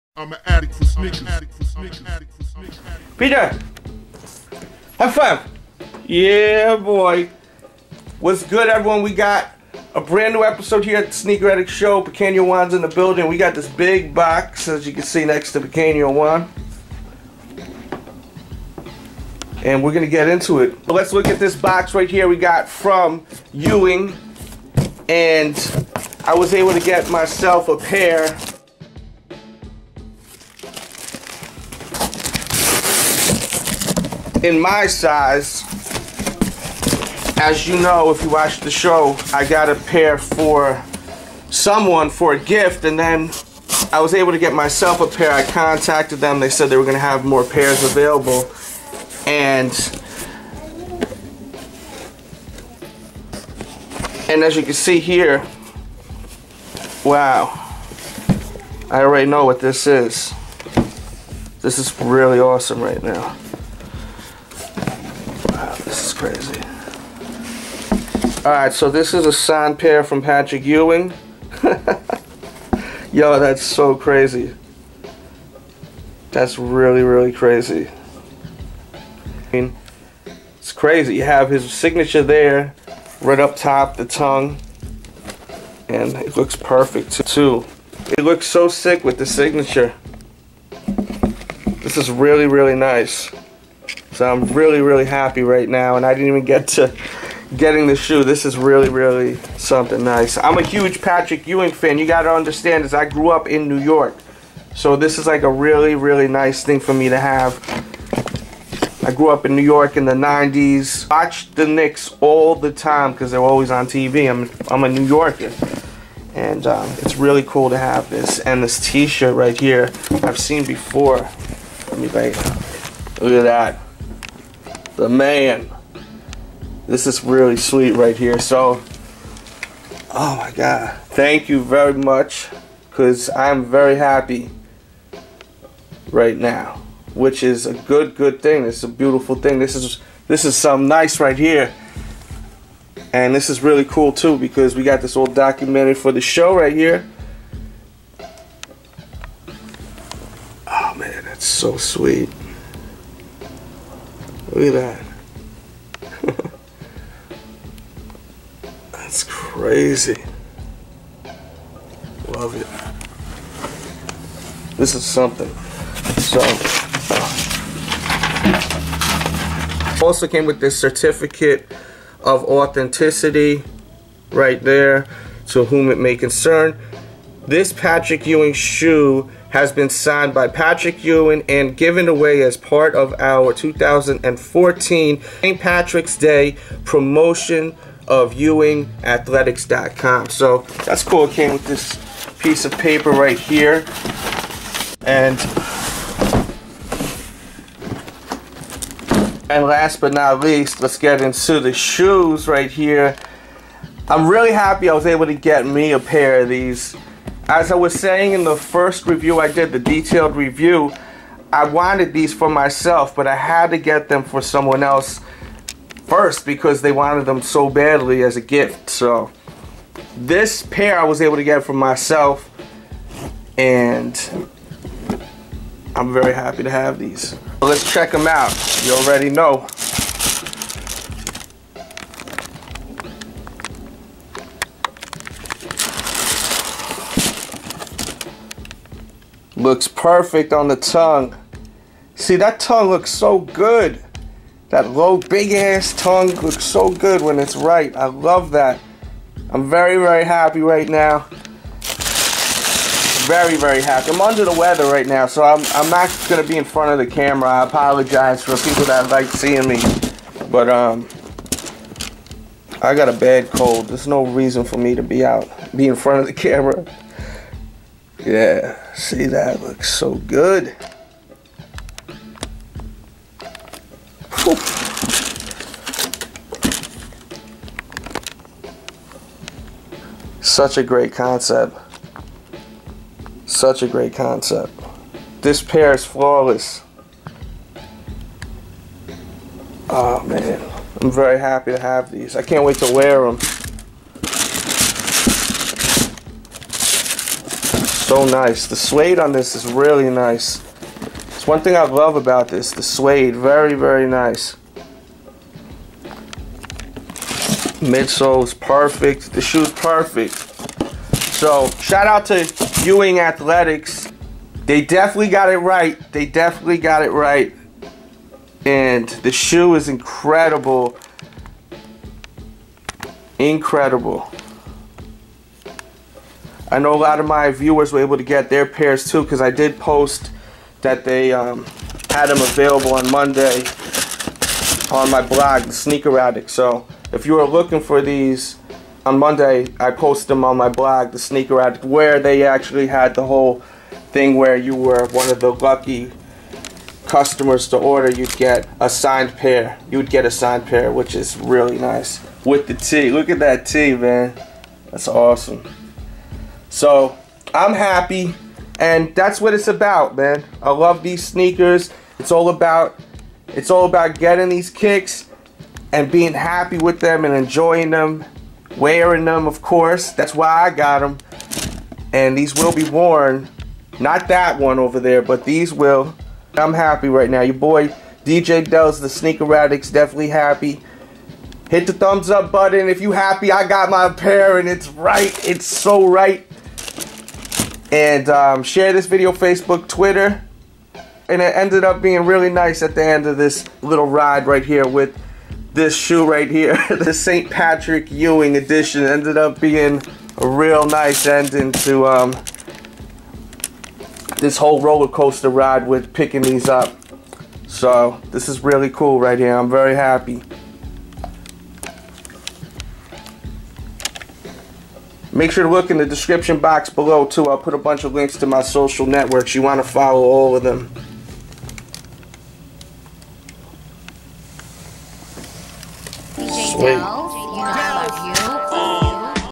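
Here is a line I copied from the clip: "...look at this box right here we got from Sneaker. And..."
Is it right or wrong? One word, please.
wrong.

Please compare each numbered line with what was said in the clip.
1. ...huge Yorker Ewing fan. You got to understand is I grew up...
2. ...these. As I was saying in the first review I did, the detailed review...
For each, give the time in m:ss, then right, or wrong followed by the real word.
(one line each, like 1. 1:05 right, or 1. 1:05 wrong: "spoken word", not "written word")
1. 1:40 wrong: "Patrick", not "Yorker"
2. 3:26 right.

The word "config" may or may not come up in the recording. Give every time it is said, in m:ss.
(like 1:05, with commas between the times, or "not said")
not said.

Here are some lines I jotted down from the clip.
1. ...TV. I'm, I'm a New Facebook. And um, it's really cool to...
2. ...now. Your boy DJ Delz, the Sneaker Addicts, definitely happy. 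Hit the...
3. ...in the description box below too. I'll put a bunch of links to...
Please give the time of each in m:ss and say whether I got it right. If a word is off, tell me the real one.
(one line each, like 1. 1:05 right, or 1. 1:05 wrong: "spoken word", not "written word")
1. 1:53 wrong: "Yorker", not "Facebook"
2. 6:17 right
3. 6:55 right.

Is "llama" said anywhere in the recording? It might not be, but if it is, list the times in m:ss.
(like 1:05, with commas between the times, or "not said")
not said.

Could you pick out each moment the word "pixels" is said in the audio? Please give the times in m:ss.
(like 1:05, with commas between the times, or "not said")
not said.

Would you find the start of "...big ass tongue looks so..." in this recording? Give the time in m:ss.
4:05.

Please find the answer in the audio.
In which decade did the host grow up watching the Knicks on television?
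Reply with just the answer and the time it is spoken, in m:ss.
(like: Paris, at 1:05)
the 90s, at 1:50.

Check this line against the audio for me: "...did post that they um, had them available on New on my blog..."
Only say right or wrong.
wrong.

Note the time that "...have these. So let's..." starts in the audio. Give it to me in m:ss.
3:46.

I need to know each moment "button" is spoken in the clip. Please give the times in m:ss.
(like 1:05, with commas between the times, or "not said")
6:22.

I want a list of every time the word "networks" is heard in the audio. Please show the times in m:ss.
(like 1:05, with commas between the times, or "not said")
6:59.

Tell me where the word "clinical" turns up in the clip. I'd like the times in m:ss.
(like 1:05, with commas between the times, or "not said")
not said.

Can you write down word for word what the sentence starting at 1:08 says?
Alright, so this is a signed pair from Patrick Ewing.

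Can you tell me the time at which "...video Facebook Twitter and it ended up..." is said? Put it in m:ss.
6:29.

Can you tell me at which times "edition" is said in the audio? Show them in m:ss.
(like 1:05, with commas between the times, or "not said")
6:38.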